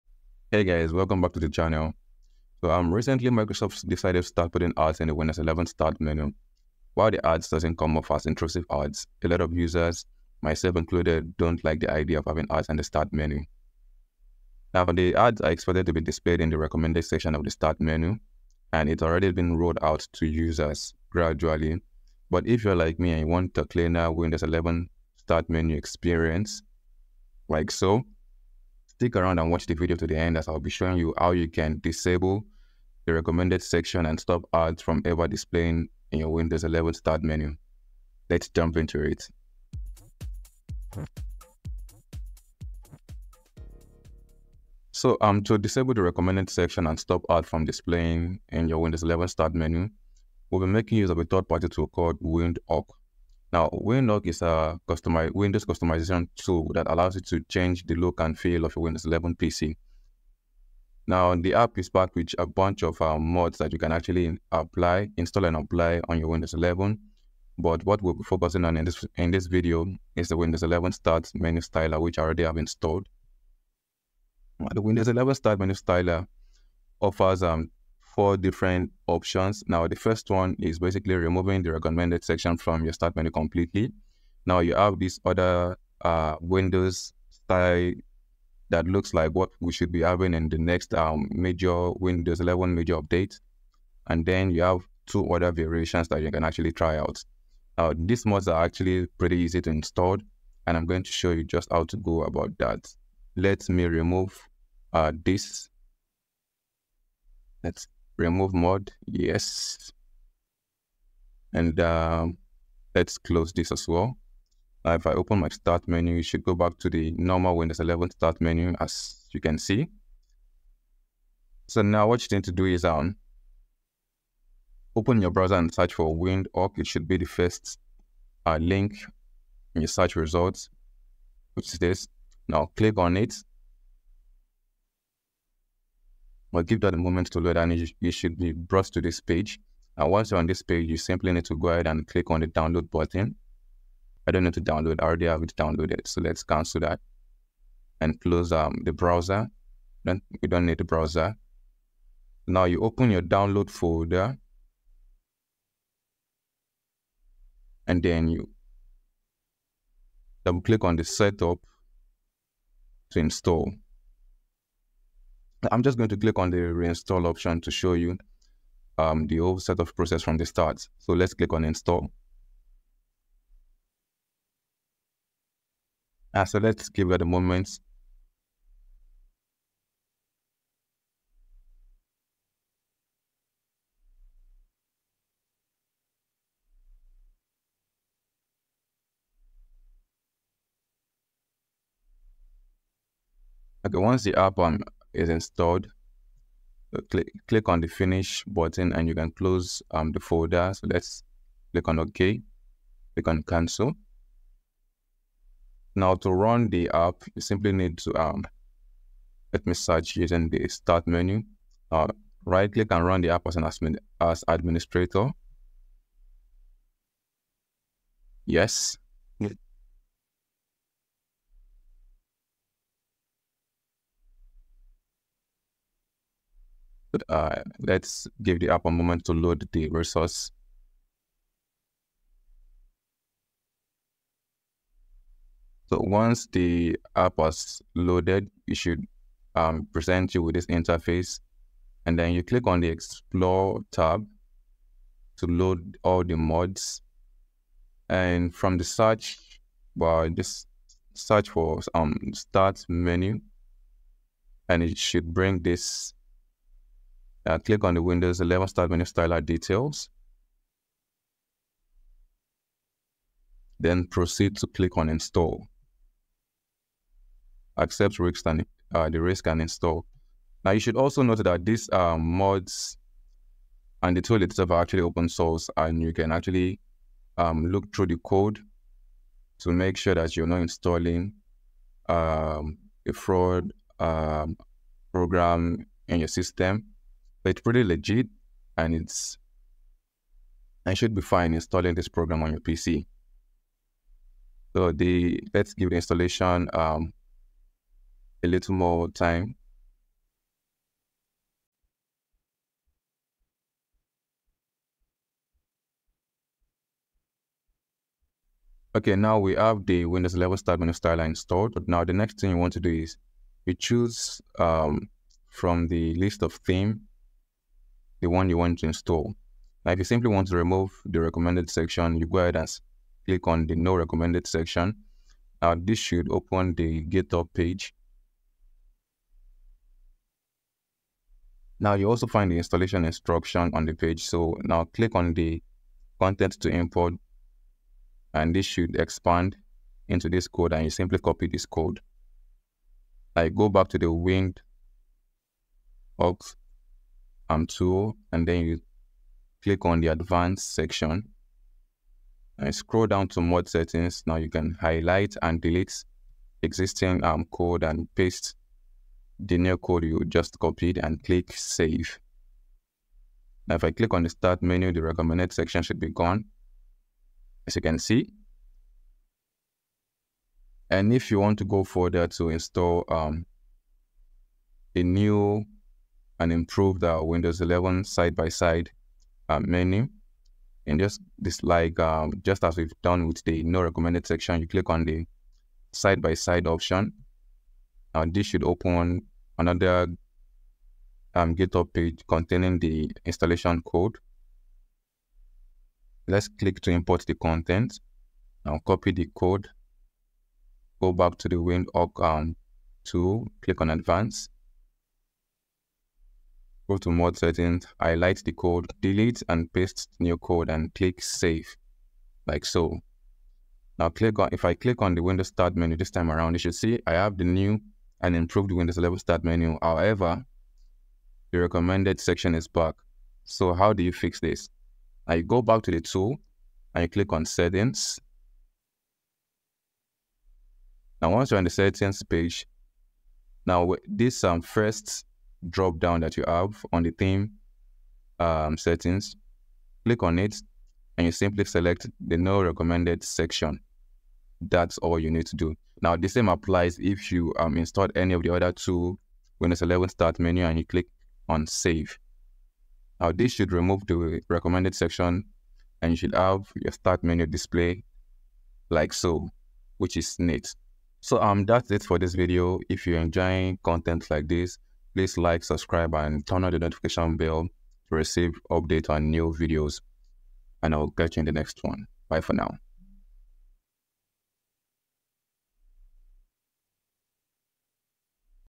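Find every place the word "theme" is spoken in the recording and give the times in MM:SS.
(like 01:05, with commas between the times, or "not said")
05:16, 07:17.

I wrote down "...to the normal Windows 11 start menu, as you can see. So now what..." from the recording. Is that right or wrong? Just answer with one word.
right.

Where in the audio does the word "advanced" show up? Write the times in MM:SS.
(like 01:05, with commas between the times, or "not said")
05:50, 06:43.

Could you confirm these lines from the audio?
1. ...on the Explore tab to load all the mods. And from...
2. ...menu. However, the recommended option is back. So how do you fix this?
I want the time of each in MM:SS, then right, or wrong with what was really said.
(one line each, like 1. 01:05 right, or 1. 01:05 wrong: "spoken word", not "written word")
1. 04:02 right
2. 06:59 wrong: "section", not "option".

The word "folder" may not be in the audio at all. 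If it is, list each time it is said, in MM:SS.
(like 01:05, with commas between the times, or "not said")
02:33, 03:20.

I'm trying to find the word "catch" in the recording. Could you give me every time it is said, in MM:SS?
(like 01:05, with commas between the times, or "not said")
07:51.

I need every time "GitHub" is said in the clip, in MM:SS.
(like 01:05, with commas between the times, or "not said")
05:27, 06:31.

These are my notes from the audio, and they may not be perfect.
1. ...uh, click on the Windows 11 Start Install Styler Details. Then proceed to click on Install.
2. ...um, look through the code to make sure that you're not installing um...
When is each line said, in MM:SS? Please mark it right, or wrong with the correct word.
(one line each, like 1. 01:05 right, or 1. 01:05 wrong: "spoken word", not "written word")
1. 04:17 wrong: "Menu", not "Install"
2. 04:37 right.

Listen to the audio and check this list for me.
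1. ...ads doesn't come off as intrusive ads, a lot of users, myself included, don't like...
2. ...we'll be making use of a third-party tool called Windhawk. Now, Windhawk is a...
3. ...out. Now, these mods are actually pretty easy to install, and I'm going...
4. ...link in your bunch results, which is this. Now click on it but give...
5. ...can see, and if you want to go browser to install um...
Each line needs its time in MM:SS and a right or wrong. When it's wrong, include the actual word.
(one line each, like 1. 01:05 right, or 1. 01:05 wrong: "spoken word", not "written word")
1. 00:07 right
2. 00:50 right
3. 01:36 right
4. 02:08 wrong: "search", not "bunch"
5. 06:07 wrong: "further", not "browser".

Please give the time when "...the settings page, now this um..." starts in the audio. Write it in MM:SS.
07:11.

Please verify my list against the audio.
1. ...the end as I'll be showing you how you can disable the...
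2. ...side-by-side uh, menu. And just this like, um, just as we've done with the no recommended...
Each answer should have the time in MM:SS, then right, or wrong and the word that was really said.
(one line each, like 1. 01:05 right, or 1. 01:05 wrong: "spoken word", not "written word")
1. 00:30 right
2. 06:18 right.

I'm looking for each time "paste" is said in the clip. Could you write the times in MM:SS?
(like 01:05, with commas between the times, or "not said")
05:58, 06:49.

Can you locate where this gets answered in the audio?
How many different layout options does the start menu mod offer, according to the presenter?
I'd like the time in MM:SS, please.
01:18.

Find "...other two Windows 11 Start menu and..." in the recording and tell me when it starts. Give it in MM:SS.
07:28.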